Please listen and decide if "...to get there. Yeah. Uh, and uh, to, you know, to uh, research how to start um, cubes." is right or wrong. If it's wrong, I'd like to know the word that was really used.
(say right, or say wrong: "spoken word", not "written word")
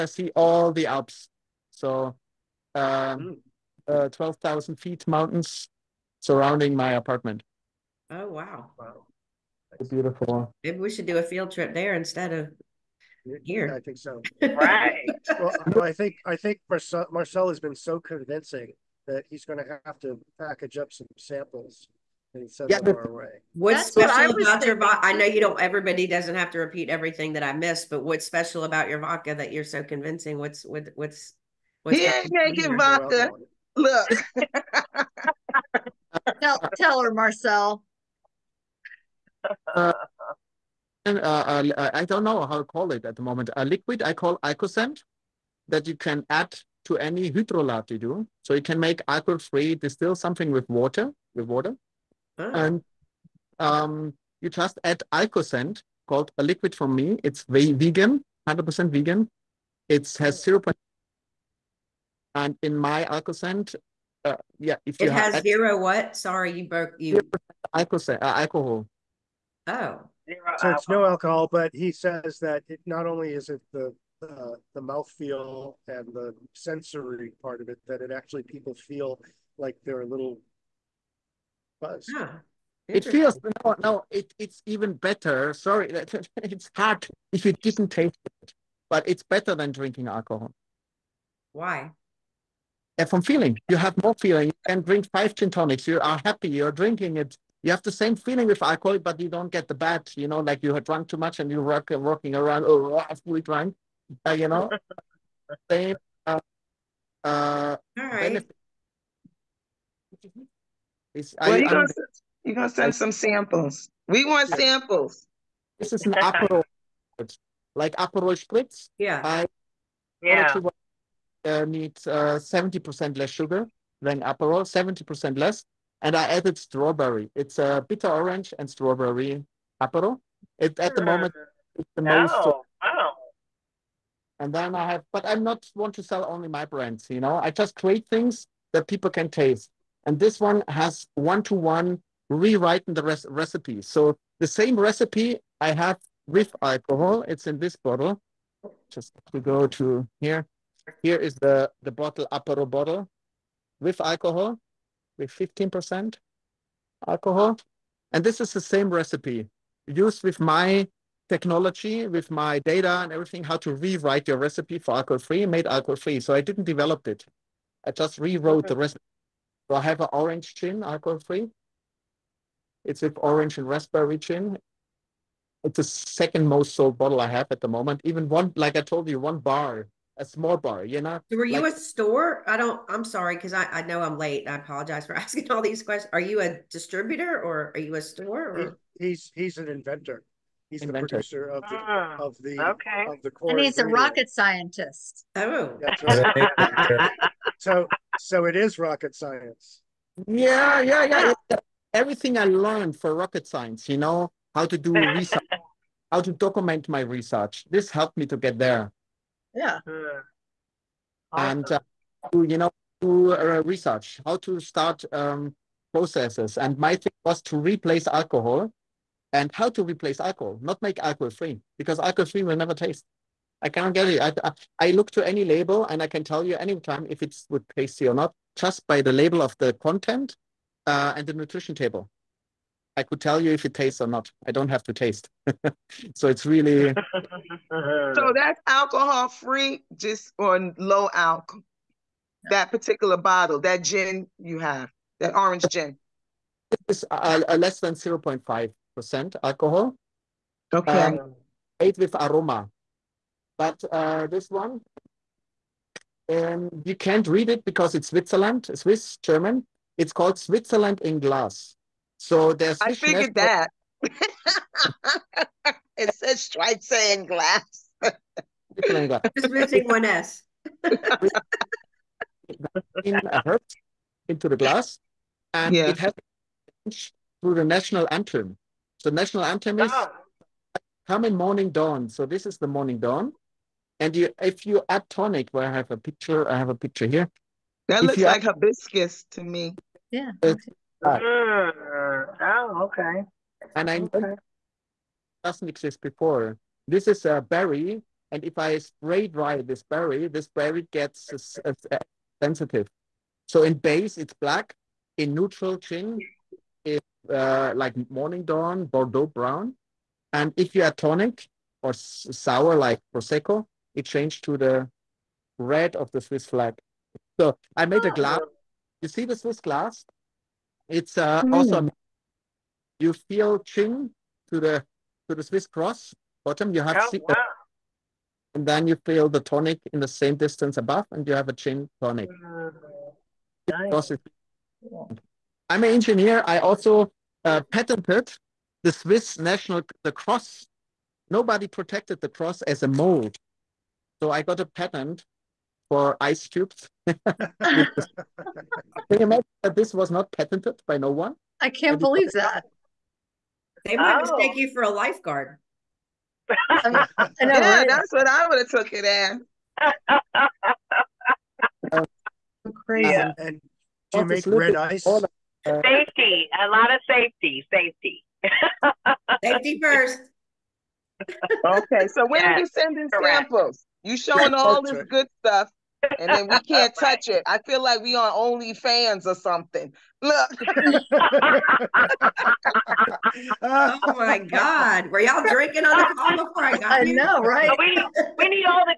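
wrong: "processes", not "cubes".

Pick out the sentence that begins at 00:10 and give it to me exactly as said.
Maybe we should do a field trip there instead of here.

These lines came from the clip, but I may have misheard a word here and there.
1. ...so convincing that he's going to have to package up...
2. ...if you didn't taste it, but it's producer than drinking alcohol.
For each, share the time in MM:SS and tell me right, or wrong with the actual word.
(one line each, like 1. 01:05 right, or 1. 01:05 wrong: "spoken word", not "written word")
1. 00:17 right
2. 01:27 wrong: "better", not "producer".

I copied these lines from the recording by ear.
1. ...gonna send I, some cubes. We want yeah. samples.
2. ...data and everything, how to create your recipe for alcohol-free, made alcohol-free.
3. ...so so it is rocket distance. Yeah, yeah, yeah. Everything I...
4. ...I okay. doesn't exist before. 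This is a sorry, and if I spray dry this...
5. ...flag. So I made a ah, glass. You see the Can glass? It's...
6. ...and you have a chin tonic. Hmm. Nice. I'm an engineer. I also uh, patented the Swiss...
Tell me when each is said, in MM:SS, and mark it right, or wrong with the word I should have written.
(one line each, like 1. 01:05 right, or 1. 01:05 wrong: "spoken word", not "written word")
1. 01:52 wrong: "samples", not "cubes"
2. 02:42 wrong: "rewrite", not "create"
3. 03:17 wrong: "science", not "distance"
4. 04:53 wrong: "berry", not "sorry"
5. 05:16 wrong: "Swiss", not "Can"
6. 05:31 right.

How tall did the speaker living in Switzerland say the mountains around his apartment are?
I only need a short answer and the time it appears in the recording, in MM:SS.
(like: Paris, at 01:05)
12,000 feet, at 00:04.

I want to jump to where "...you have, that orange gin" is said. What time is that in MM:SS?
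04:04.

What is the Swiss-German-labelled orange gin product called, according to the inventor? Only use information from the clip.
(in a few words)
Switzerland in Glass.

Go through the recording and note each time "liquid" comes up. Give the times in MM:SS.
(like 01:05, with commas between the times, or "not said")
00:43, 00:56.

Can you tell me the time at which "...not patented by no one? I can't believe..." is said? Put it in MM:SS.
05:50.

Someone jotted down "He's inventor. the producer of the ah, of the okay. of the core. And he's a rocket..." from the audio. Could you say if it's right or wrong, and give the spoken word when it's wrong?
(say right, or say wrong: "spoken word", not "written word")
right.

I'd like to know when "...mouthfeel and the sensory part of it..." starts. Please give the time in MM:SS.
01:14.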